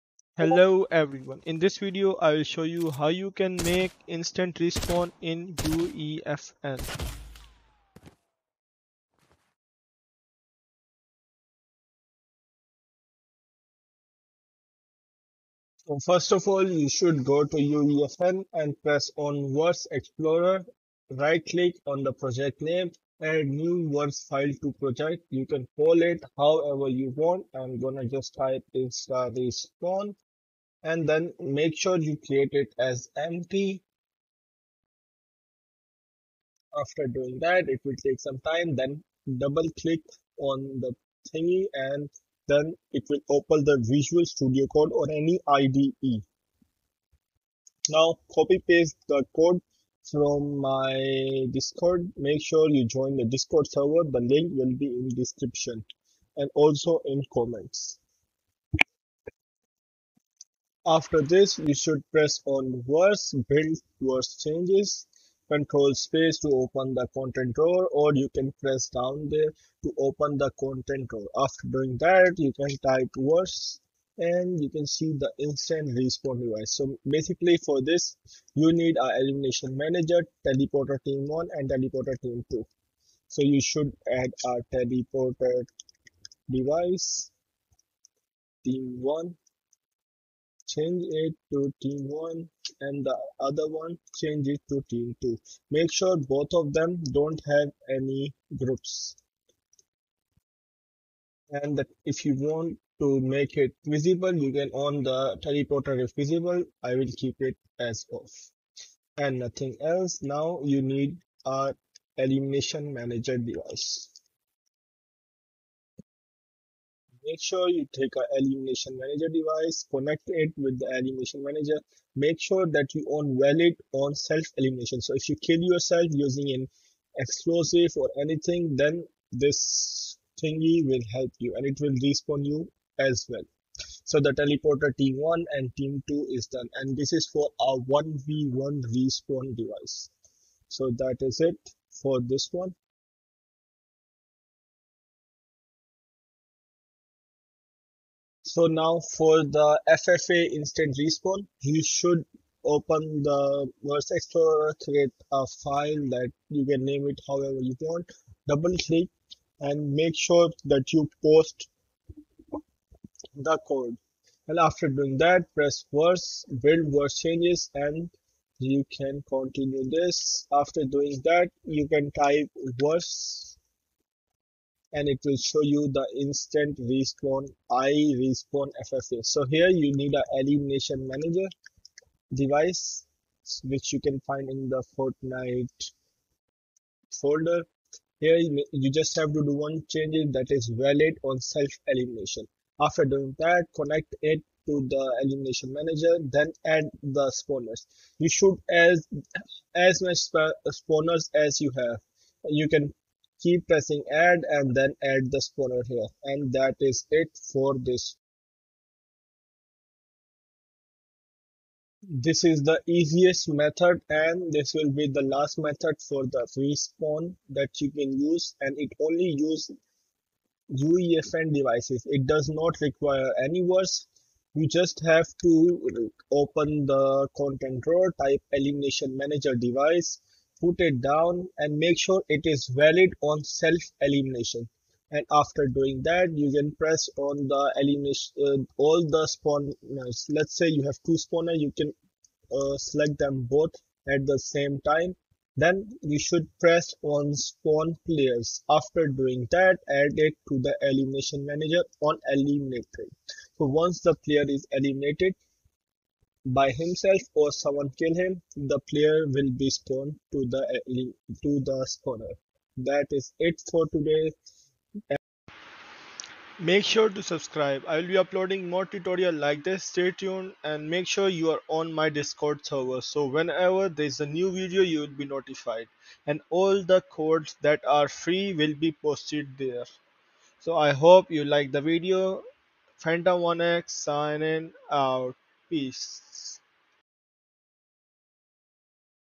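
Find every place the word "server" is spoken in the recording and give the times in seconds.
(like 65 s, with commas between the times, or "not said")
53 s, 272 s.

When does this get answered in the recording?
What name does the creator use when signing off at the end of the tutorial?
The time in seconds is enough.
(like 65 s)
282 s.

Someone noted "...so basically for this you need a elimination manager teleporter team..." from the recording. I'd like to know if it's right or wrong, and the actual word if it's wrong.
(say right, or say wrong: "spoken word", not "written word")
right.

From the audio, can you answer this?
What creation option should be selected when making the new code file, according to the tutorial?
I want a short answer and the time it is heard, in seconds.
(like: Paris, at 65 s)
empty, at 33 s.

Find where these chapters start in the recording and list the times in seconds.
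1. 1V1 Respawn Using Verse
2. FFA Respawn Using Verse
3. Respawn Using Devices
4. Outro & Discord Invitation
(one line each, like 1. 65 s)
1. 10 s
2. 143 s
3. 209 s
4. 265 s.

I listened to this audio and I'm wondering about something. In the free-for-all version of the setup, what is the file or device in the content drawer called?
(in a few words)
i respawn ffa.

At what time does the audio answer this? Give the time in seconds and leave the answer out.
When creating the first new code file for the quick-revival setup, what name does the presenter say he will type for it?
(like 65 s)
28 s.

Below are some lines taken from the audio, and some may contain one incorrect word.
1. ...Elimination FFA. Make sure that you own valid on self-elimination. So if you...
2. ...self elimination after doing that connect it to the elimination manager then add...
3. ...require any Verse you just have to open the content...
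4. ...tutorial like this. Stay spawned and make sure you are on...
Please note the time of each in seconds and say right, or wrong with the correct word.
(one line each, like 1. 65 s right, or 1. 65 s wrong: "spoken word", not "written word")
1. 120 s wrong: "Manager", not "FFA"
2. 191 s right
3. 222 s right
4. 268 s wrong: "tuned", not "spawned".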